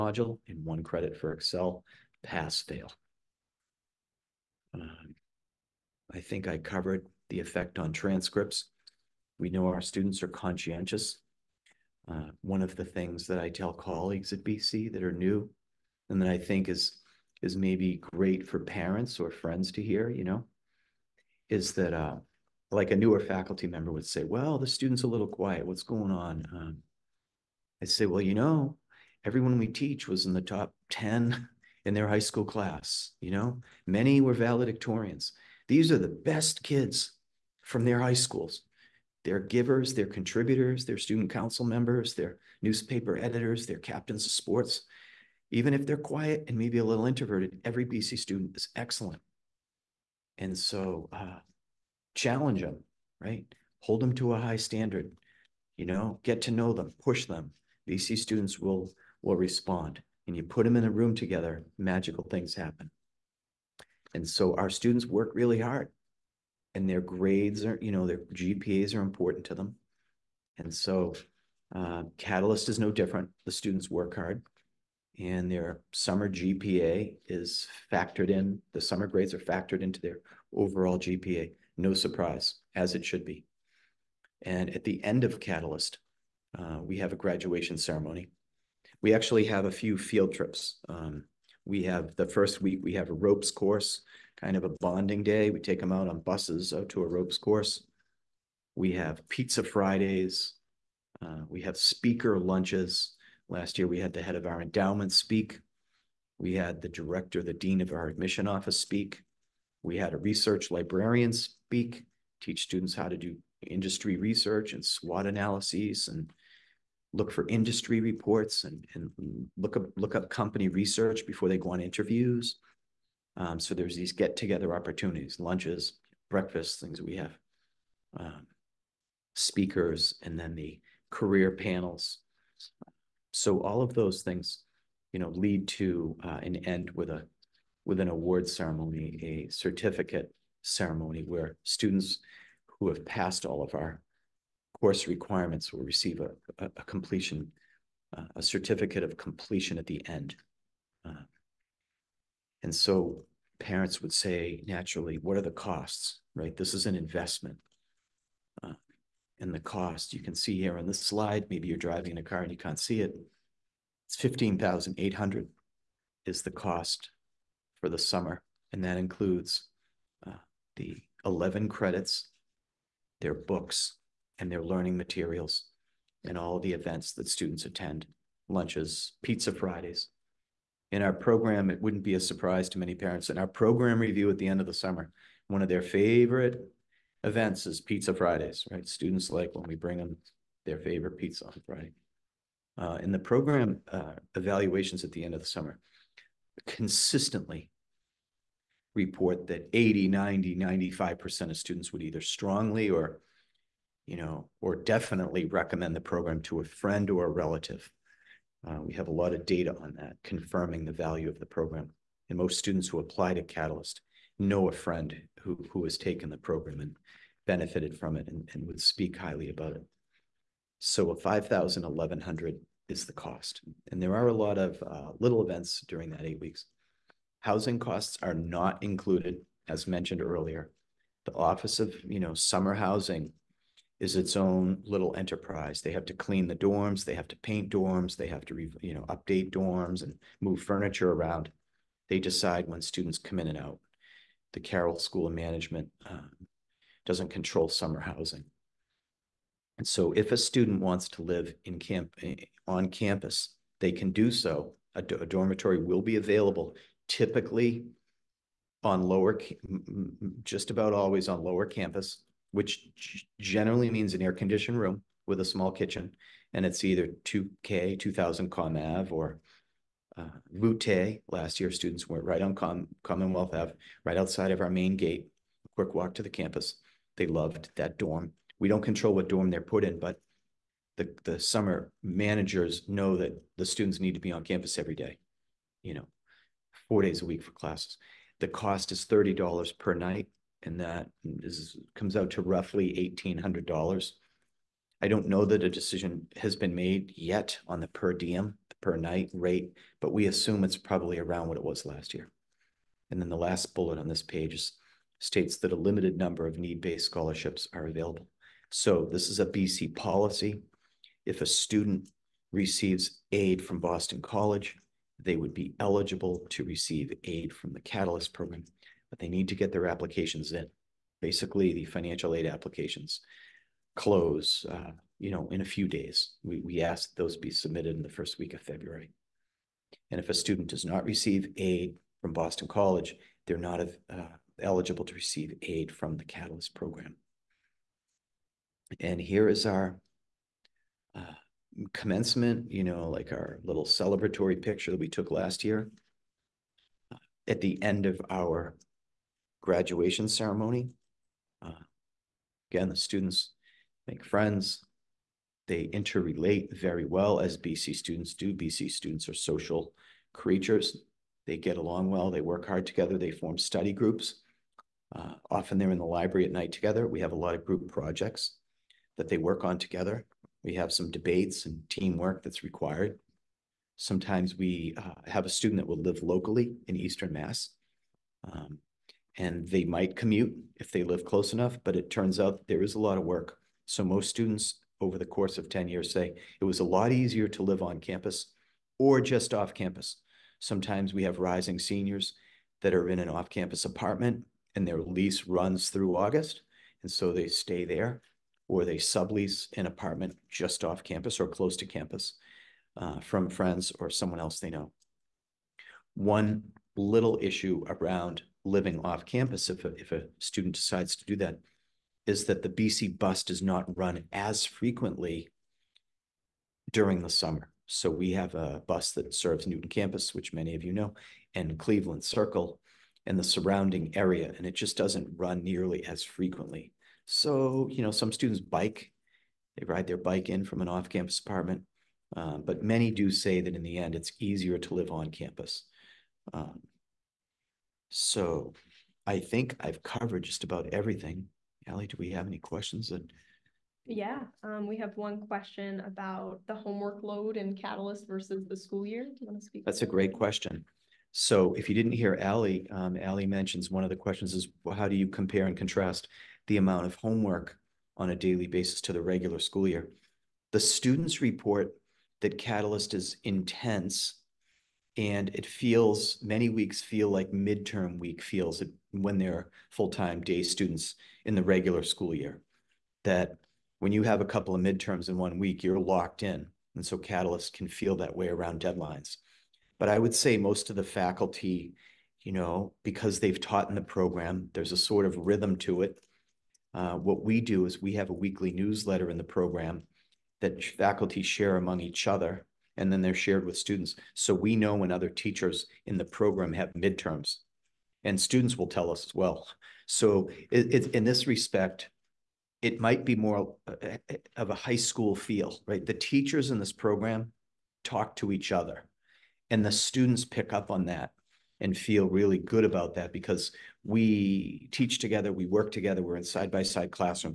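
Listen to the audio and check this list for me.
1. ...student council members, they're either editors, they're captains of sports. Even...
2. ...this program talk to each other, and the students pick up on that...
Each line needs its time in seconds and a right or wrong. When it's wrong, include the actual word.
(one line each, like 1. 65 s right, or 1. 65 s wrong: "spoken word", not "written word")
1. 40 s wrong: "newspaper", not "either"
2. 506 s right.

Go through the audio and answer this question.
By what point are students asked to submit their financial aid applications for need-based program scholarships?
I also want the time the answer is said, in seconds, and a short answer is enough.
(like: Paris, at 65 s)
First week of February, at 328 s.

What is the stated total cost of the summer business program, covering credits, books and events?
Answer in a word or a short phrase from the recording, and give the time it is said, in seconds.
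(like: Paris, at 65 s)
$15,800, at 164 s.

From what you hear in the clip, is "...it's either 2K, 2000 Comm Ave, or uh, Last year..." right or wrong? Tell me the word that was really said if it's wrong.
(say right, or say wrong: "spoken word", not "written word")
right.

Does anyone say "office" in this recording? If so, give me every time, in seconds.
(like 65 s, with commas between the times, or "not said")
108 s, 231 s.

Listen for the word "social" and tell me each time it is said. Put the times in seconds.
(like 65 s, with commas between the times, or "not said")
359 s.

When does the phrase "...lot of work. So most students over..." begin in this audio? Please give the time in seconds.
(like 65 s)
382 s.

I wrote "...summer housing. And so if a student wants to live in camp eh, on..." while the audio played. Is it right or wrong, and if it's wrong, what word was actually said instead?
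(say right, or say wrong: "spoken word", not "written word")
right.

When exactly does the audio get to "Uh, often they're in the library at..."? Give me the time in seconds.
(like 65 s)
365 s.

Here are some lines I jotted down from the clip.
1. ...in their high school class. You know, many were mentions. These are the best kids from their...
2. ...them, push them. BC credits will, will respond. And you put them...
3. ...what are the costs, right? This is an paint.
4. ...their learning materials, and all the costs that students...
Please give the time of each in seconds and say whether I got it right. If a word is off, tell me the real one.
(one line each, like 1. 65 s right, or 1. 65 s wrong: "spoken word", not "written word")
1. 31 s wrong: "valedictorians", not "mentions"
2. 56 s wrong: "students", not "credits"
3. 155 s wrong: "investment", not "paint"
4. 174 s wrong: "events", not "costs".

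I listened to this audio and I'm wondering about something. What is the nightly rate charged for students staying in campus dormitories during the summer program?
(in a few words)
$30.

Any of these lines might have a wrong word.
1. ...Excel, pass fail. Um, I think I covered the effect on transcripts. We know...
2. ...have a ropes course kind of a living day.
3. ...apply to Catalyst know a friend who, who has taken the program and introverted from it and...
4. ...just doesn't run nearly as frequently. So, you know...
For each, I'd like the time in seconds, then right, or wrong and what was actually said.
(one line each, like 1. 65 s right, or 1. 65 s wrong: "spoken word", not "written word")
1. 1 s right
2. 92 s wrong: "bonding", not "living"
3. 212 s wrong: "benefited", not "introverted"
4. 424 s right.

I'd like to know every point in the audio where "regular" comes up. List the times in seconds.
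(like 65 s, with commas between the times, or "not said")
459 s, 471 s.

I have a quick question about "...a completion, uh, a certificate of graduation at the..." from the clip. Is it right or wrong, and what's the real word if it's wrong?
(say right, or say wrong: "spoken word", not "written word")
wrong: "completion", not "graduation".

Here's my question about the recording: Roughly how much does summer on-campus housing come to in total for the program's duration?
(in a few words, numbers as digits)
$1,800.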